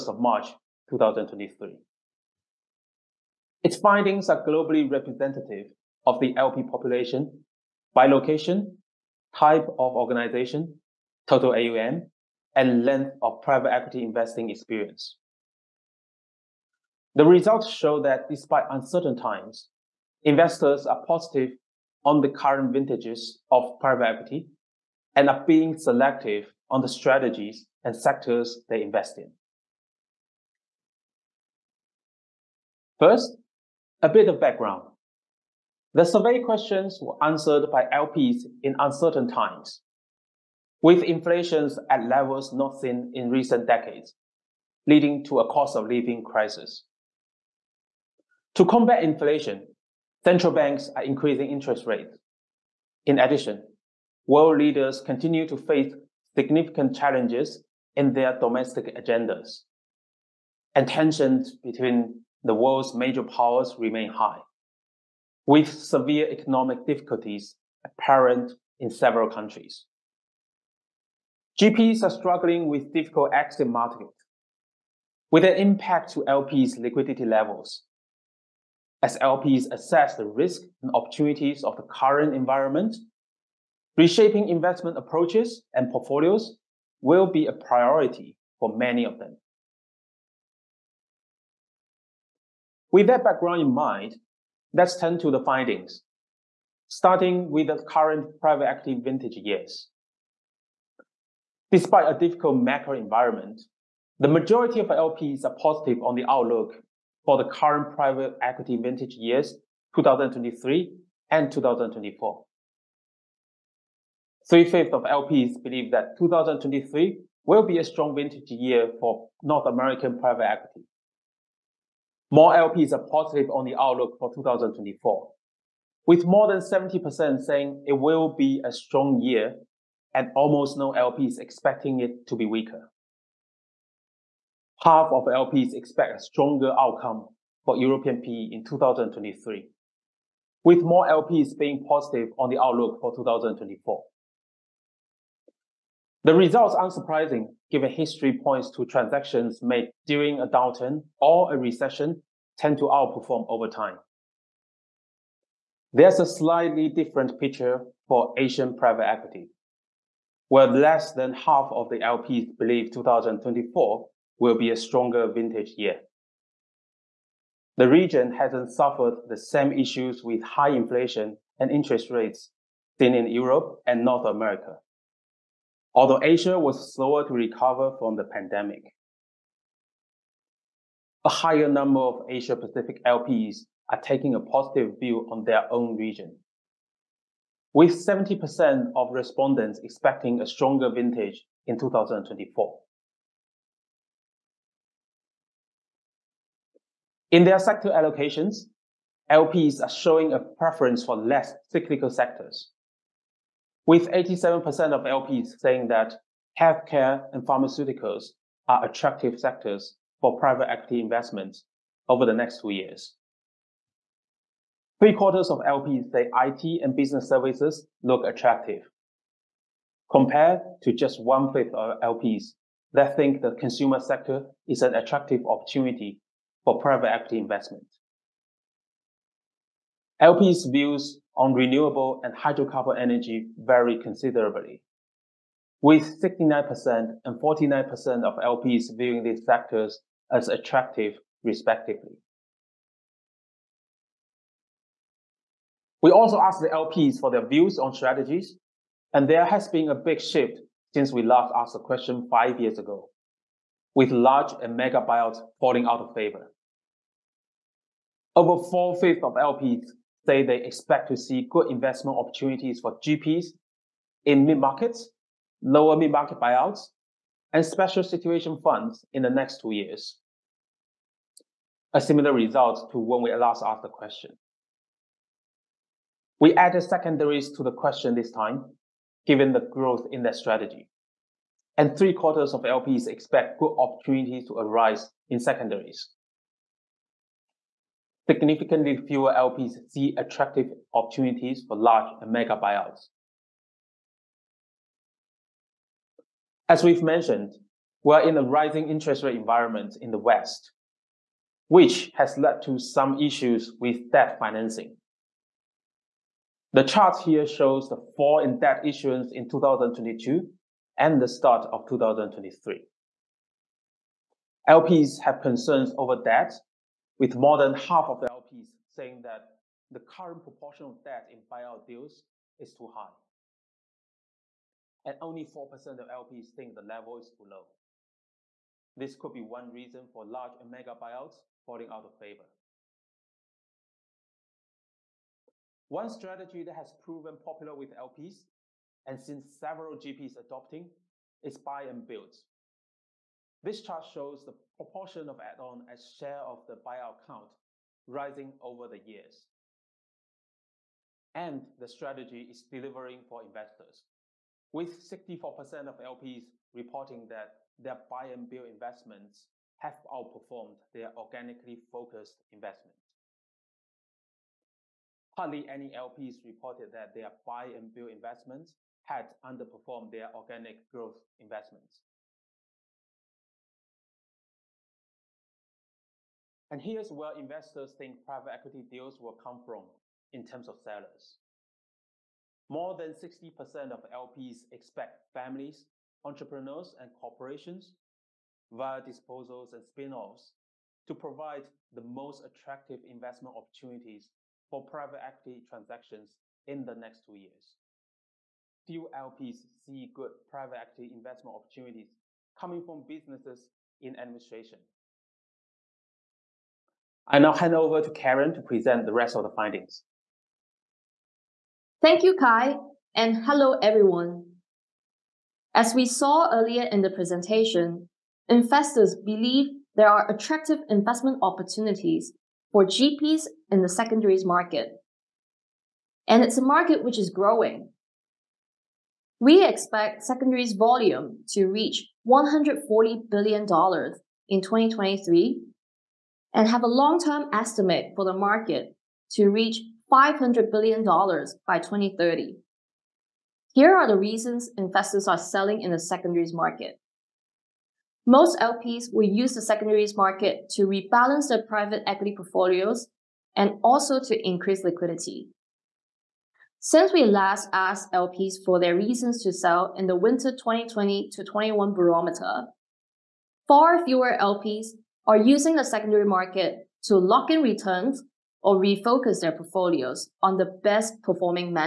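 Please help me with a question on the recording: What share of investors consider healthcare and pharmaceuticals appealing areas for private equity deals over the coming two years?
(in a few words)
87%.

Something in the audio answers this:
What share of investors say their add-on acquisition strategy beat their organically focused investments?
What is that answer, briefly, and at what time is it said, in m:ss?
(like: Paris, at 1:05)
64%, at 5:54.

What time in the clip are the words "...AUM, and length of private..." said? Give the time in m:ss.
0:11.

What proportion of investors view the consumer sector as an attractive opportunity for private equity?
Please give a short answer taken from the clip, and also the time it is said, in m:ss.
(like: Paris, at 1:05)
one fifth, at 3:40.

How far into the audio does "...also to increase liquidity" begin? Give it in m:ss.
7:33.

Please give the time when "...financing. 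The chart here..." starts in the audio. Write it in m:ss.
5:04.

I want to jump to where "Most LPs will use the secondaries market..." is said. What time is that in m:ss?
7:28.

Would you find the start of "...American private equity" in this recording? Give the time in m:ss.
1:59.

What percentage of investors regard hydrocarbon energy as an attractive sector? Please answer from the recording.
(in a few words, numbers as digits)
49%.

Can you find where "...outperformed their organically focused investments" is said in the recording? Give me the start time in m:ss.
6:00.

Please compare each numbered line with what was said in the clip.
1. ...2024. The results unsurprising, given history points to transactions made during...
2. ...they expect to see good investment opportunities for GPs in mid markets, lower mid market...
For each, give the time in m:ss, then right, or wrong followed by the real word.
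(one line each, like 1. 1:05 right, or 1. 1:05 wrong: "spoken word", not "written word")
1. 2:23 right
2. 4:20 right.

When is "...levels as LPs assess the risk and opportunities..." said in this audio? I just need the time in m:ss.
1:17.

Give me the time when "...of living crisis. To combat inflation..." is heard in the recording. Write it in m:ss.
0:45.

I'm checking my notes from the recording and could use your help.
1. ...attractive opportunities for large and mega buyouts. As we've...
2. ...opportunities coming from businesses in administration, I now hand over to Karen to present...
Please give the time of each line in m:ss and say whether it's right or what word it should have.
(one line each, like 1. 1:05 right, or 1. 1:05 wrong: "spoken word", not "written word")
1. 4:50 right
2. 6:41 right.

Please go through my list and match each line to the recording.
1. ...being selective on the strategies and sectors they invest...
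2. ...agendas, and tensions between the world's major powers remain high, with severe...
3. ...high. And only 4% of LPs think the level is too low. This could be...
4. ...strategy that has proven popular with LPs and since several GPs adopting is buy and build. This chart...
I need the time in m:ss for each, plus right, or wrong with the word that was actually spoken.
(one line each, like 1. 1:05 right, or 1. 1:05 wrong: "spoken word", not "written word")
1. 0:25 right
2. 0:58 right
3. 5:22 right
4. 5:36 right.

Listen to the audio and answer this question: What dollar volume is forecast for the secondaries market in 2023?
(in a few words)
$140 billion.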